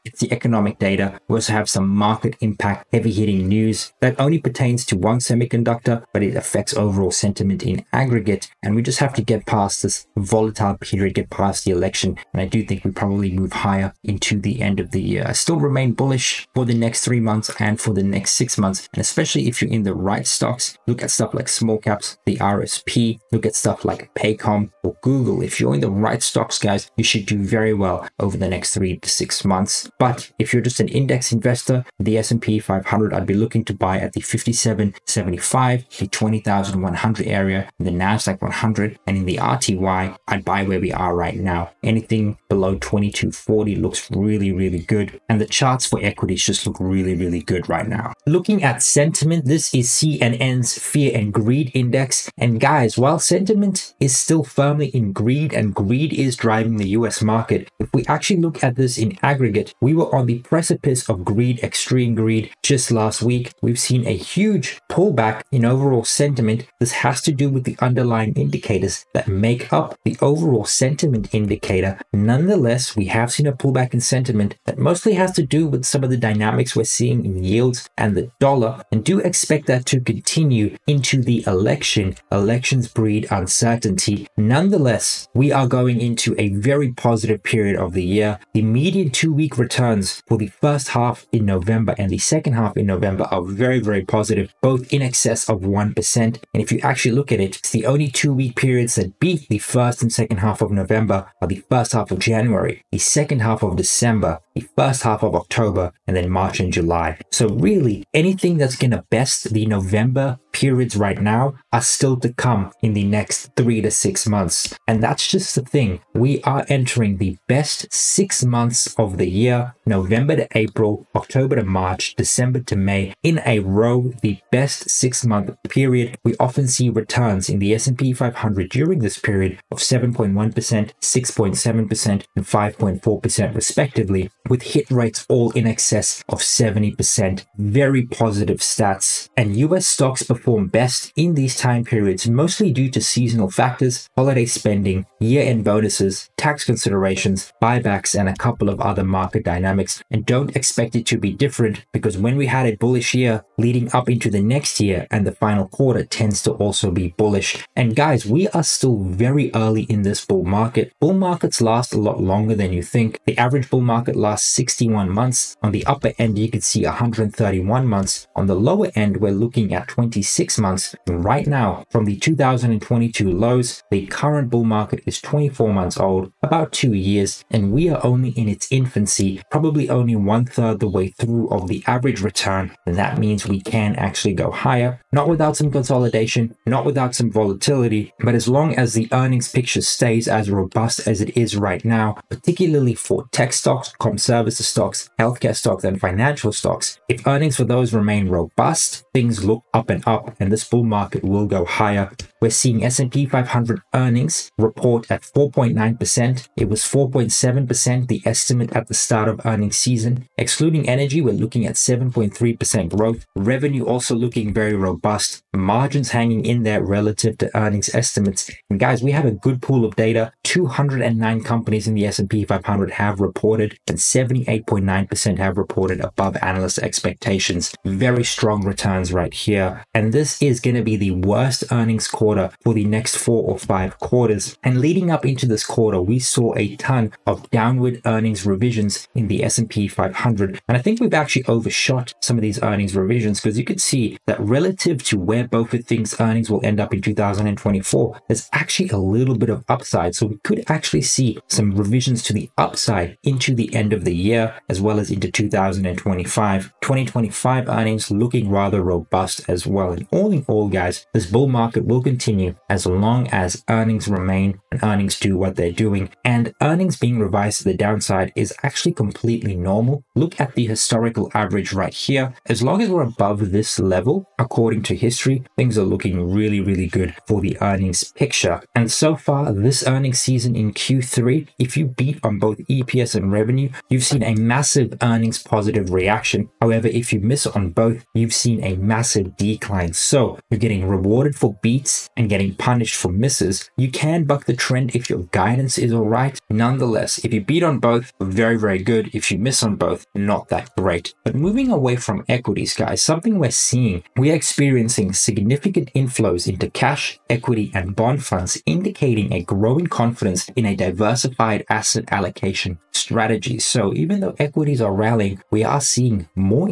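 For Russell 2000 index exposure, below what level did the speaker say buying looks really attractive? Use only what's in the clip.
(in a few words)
2240.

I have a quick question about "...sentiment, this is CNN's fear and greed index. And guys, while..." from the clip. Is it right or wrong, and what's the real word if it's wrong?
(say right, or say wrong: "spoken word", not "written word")
right.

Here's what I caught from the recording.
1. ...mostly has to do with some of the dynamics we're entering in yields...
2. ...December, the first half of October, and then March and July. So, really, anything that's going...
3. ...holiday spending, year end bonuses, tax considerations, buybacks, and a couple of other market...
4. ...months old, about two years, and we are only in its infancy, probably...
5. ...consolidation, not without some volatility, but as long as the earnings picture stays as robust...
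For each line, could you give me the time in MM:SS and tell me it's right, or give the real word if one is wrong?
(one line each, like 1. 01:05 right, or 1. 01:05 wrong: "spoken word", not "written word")
1. 01:14 wrong: "seeing", not "entering"
2. 01:43 right
3. 02:24 right
4. 02:55 right
5. 03:05 right.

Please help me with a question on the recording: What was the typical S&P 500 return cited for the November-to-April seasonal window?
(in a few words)
7.1%.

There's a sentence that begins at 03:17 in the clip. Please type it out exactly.
If earnings for those remain robust, things look up and up, and this bull market will go higher.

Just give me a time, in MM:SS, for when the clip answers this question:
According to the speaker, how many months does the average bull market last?
02:44.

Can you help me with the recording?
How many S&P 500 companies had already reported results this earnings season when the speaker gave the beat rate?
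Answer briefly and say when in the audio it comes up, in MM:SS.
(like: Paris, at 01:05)
209, at 03:40.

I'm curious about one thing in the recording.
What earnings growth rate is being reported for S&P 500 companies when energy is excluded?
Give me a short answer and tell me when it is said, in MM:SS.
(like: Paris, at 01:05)
7.3%, at 03:31.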